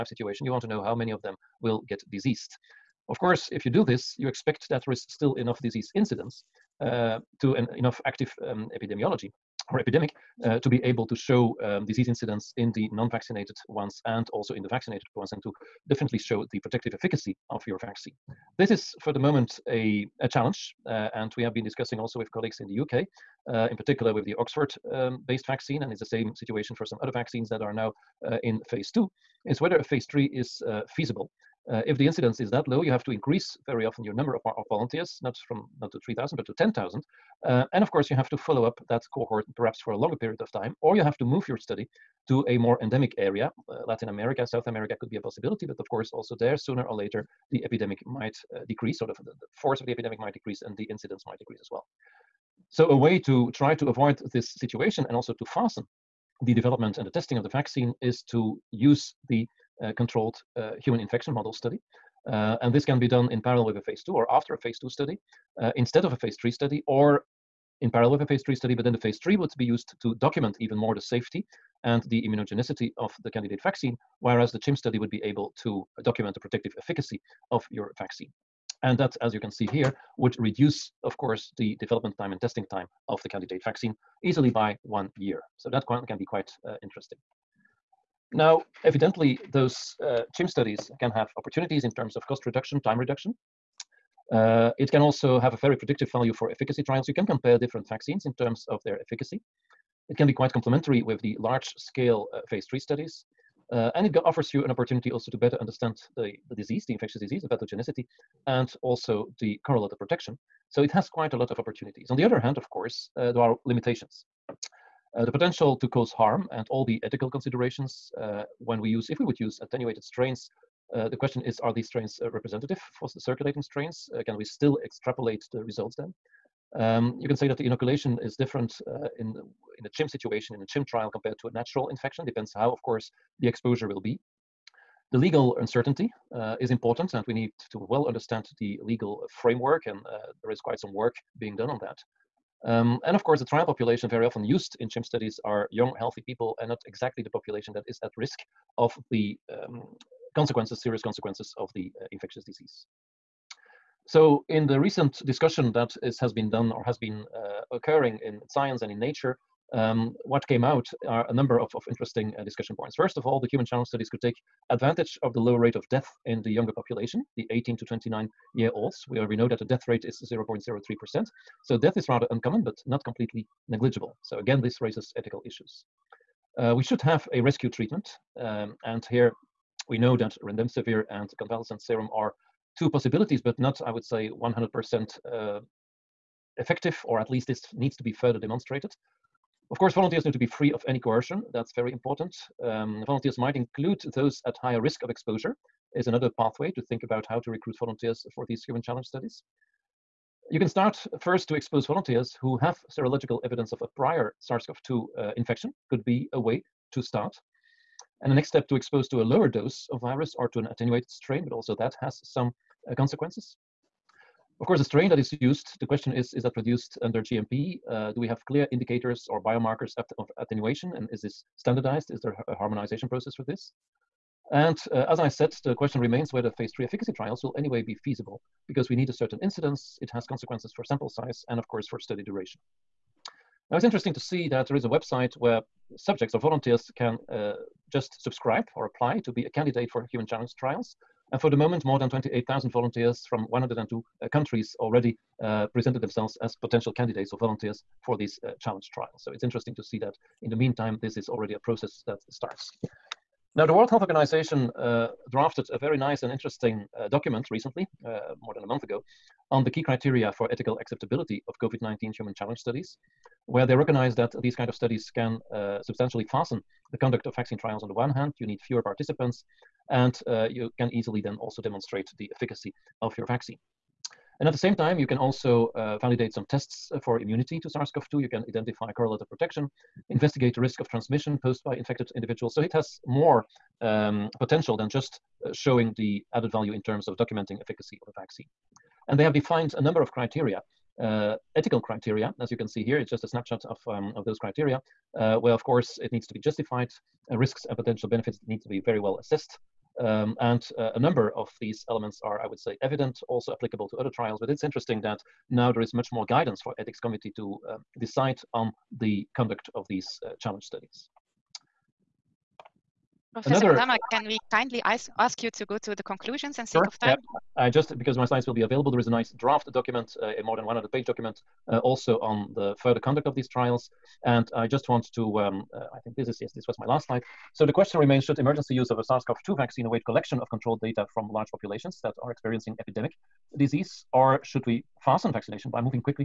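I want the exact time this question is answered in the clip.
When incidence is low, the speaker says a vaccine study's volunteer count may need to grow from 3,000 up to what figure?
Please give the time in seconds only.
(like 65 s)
36 s.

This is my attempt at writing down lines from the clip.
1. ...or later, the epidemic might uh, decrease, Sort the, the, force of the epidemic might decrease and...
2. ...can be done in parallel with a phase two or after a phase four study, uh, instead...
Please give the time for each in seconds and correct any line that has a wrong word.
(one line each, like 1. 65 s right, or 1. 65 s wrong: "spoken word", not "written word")
1. 46 s right
2. 62 s wrong: "two", not "four".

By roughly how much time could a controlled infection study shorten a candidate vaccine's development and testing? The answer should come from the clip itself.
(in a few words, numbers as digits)
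one year.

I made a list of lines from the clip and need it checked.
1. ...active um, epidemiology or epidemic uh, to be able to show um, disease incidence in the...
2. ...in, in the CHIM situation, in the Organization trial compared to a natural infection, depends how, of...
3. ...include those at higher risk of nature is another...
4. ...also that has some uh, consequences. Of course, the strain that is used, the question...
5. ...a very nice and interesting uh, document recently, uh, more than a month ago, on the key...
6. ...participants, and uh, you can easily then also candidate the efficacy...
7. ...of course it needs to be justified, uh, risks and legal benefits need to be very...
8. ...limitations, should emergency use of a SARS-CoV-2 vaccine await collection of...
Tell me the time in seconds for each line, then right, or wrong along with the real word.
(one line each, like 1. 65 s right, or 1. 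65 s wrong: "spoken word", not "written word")
1. 8 s right
2. 129 s wrong: "CHIM", not "Organization"
3. 193 s wrong: "exposure", not "nature"
4. 211 s right
5. 255 s right
6. 268 s wrong: "demonstrate", not "candidate"
7. 295 s wrong: "potential", not "legal"
8. 327 s wrong: "remains", not "limitations".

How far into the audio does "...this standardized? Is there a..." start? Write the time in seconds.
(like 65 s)
221 s.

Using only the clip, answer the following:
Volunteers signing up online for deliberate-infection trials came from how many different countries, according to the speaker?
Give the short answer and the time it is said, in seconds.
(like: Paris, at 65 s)
102, at 243 s.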